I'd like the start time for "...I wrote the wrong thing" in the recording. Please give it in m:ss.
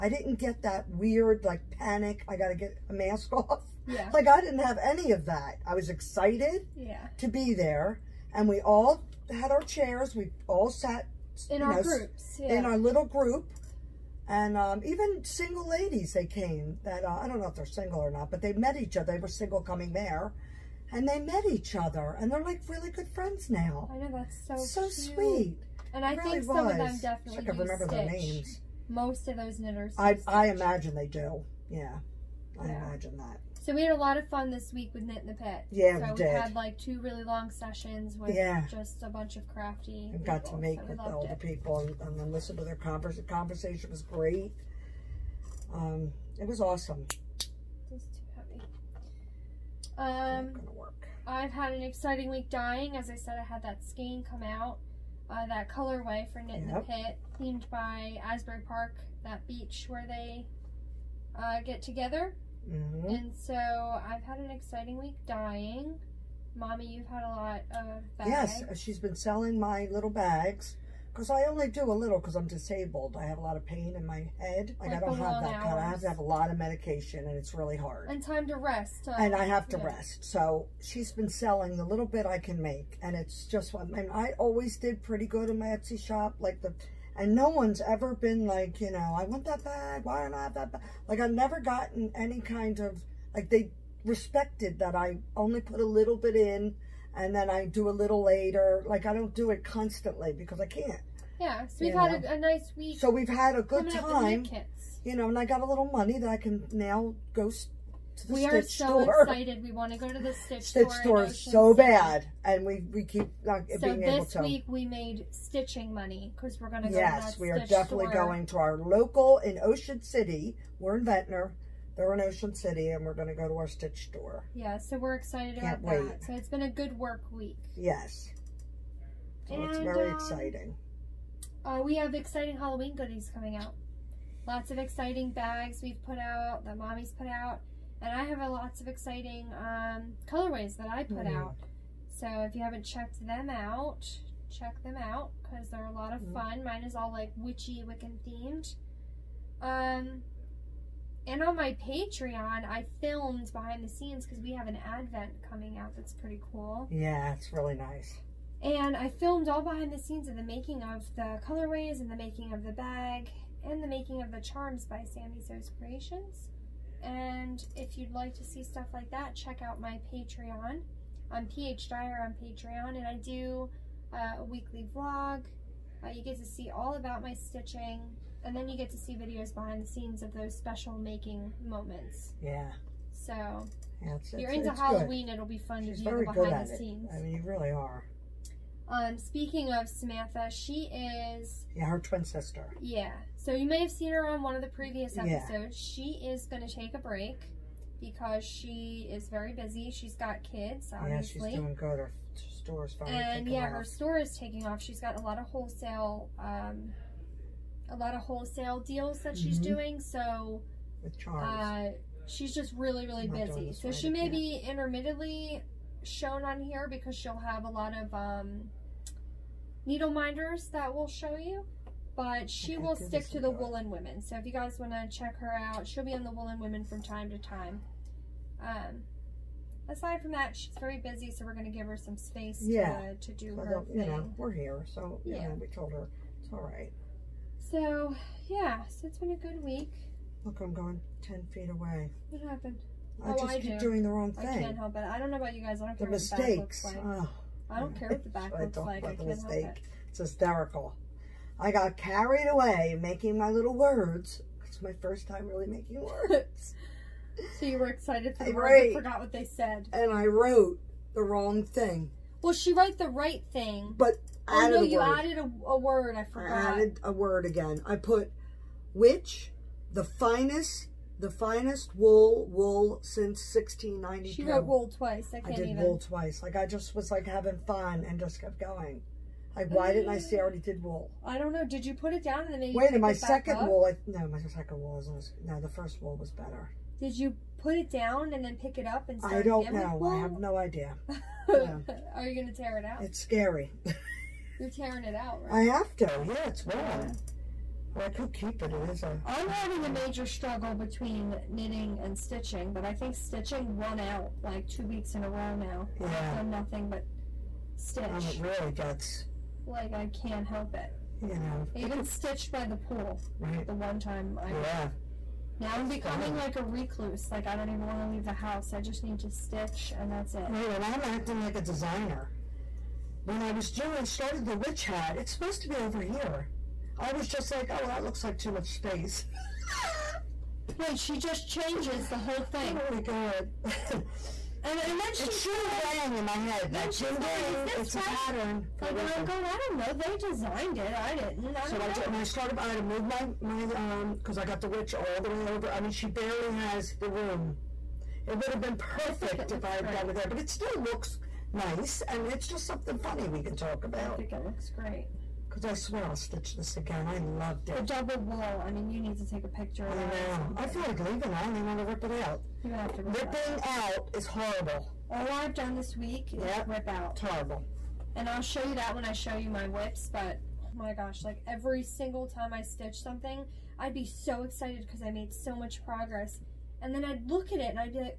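4:20.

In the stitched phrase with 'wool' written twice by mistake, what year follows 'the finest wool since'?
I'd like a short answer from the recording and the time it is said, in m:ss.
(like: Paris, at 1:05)
1692, at 4:33.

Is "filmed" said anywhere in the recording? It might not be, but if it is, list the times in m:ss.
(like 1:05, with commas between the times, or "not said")
2:32, 2:39.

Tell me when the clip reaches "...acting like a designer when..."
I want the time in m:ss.
5:21.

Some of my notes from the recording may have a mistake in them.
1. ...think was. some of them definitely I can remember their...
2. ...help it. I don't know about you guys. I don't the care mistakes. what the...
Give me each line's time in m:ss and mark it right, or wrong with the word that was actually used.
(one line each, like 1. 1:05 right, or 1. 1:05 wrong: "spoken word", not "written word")
1. 0:26 right
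2. 4:04 right.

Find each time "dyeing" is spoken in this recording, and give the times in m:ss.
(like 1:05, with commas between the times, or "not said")
0:52, 1:05.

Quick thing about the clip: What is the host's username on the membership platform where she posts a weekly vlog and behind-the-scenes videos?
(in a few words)
PH Dyer.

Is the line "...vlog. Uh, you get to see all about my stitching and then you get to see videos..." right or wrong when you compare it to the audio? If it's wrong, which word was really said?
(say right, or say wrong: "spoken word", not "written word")
right.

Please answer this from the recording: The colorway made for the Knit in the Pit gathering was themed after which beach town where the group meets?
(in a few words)
Asbury Park.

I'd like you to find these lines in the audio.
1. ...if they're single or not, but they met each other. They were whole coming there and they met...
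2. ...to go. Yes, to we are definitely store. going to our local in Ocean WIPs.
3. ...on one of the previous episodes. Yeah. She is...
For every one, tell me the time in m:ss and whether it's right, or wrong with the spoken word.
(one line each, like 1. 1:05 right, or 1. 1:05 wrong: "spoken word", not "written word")
1. 0:17 wrong: "single", not "whole"
2. 1:56 wrong: "City", not "WIPs"
3. 3:14 right.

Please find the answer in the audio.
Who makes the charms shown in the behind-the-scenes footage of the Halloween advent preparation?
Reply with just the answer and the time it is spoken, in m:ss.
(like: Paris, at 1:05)
Sami Sews Creations, at 2:45.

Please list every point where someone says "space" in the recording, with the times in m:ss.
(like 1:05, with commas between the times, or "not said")
3:52, 5:28.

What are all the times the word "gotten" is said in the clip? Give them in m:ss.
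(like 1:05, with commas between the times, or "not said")
1:31.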